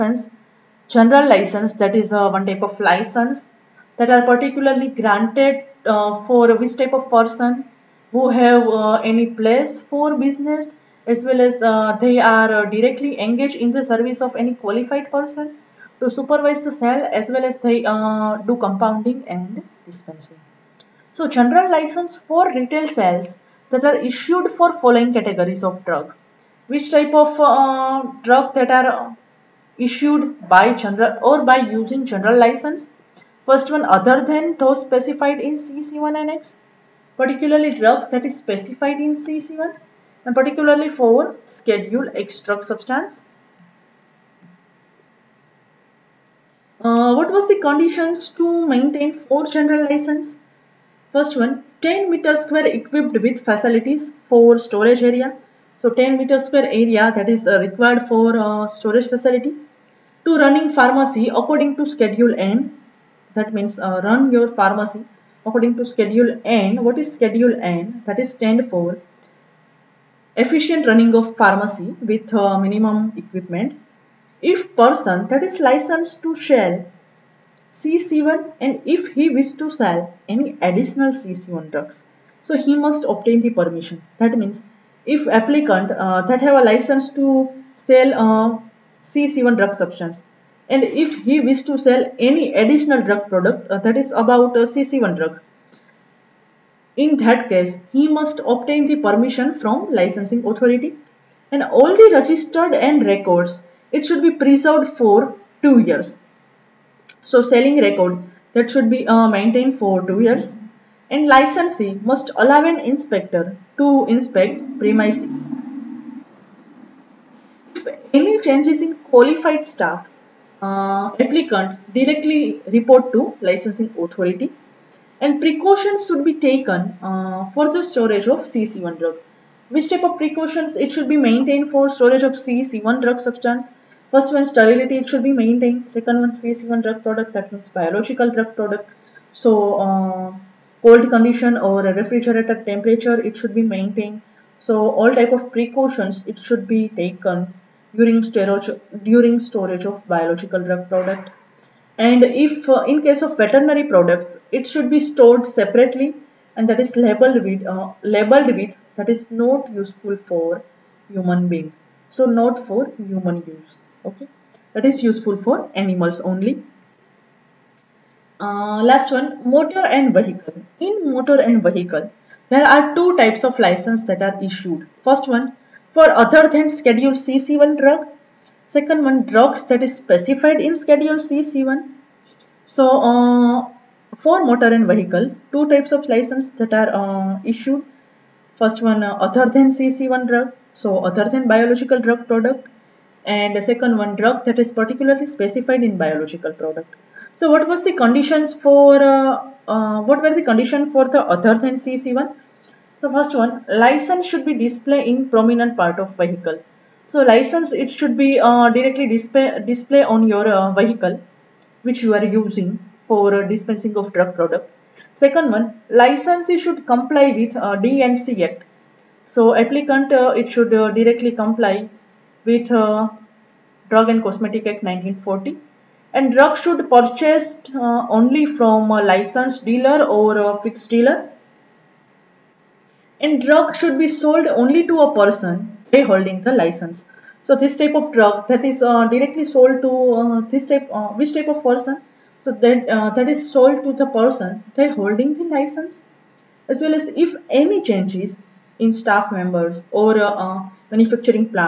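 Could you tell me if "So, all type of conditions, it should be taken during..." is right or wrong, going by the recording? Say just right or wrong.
wrong.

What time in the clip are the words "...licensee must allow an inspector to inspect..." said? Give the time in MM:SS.
01:51.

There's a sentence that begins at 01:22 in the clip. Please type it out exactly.
So he must obtain the permission.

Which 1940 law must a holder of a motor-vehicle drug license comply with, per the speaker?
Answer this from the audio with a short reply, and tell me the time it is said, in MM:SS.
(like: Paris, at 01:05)
Drug and Cosmetic Act, at 03:43.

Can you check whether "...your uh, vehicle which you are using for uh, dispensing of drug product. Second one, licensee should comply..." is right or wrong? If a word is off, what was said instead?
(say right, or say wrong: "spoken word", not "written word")
right.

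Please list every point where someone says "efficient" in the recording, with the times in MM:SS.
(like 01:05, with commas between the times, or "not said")
01:10.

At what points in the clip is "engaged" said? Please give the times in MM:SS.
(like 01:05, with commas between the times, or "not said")
00:13.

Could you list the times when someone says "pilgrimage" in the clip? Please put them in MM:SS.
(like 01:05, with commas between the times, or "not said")
not said.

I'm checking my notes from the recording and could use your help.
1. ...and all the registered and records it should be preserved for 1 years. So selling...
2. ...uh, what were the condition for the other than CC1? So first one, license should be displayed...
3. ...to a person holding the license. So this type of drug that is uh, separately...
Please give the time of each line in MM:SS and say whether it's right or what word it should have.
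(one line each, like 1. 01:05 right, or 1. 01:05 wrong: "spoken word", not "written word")
1. 01:41 wrong: "2", not "1"
2. 03:19 right
3. 03:54 wrong: "directly", not "separately".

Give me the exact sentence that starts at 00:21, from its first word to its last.
So general license for retail sales that are issued for following categories of drug.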